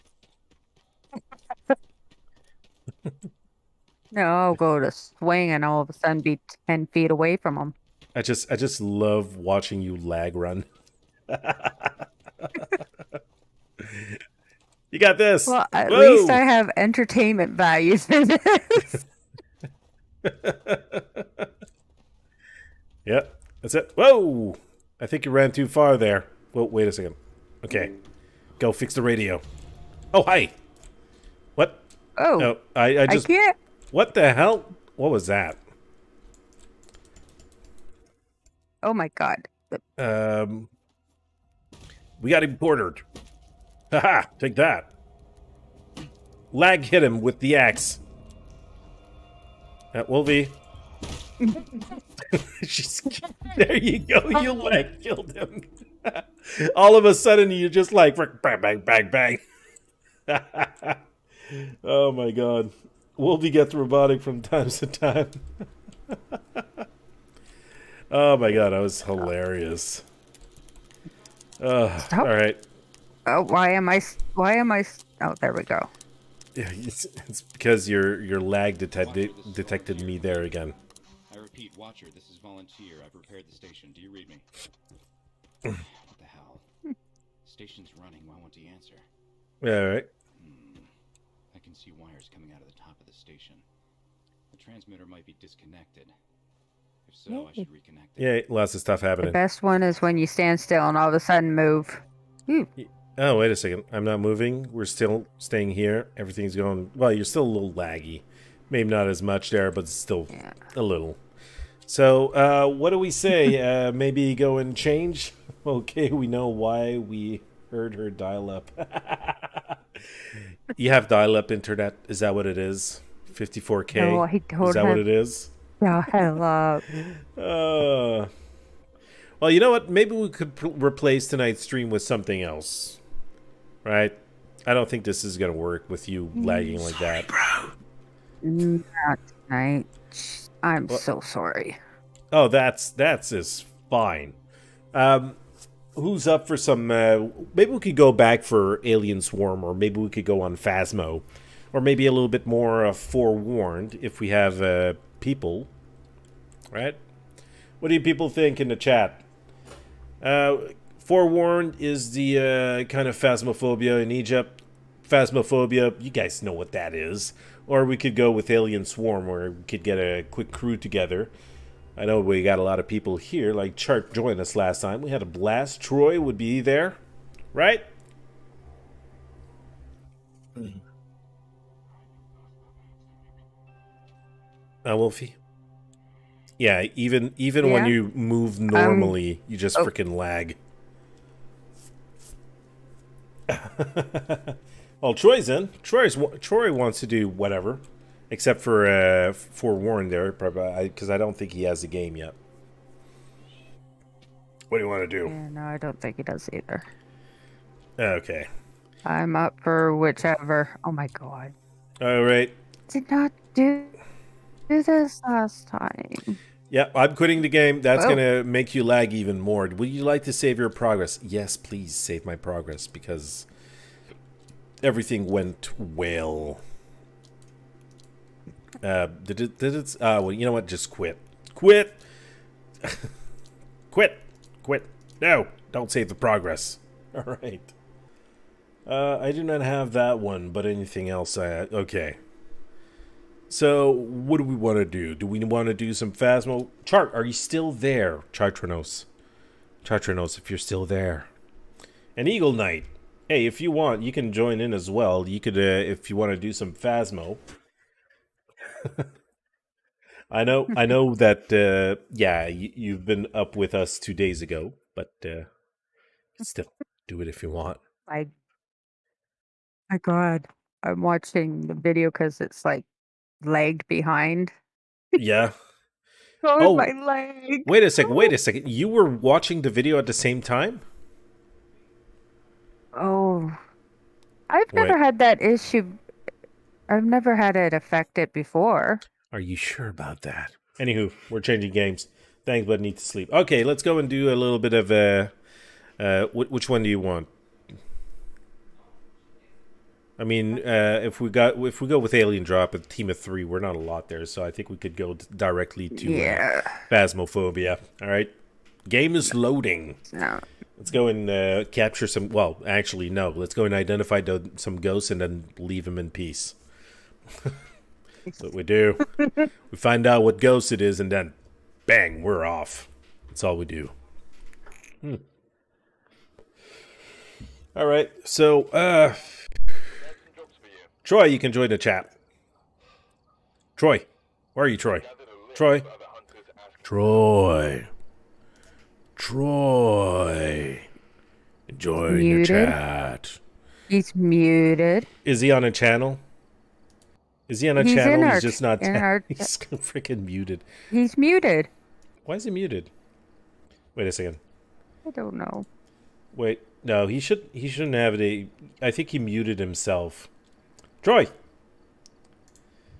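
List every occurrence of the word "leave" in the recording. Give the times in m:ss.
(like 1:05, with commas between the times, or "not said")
5:15.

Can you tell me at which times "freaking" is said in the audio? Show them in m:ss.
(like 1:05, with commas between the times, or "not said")
3:09, 5:49.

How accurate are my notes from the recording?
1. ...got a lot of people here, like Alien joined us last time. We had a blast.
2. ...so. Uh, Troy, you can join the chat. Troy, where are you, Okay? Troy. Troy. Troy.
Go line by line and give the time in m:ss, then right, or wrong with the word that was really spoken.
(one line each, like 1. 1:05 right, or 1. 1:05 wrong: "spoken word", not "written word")
1. 2:52 wrong: "Chart", not "Alien"
2. 5:28 wrong: "Troy", not "Okay".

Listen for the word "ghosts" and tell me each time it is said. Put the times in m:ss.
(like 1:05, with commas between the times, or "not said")
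5:14, 5:20.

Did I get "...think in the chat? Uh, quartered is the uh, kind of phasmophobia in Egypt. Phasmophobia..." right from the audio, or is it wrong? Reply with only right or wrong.
wrong.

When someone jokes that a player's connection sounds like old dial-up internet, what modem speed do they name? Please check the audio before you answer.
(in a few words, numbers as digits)
54K.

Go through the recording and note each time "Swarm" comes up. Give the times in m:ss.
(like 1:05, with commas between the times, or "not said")
2:29, 2:48.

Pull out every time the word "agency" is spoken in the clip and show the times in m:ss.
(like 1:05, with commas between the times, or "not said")
not said.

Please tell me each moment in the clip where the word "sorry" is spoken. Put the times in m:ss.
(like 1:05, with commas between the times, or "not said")
2:16, 2:21.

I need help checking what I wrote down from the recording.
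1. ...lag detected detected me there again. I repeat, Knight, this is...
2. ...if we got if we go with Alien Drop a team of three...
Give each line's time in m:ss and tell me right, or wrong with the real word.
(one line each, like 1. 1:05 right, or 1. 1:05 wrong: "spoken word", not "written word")
1. 1:18 wrong: "Watcher", not "Knight"
2. 5:01 right.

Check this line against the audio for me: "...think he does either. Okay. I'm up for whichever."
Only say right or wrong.
right.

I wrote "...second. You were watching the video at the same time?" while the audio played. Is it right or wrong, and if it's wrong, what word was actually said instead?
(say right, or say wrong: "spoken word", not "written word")
right.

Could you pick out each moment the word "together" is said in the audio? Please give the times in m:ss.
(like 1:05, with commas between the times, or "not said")
2:50.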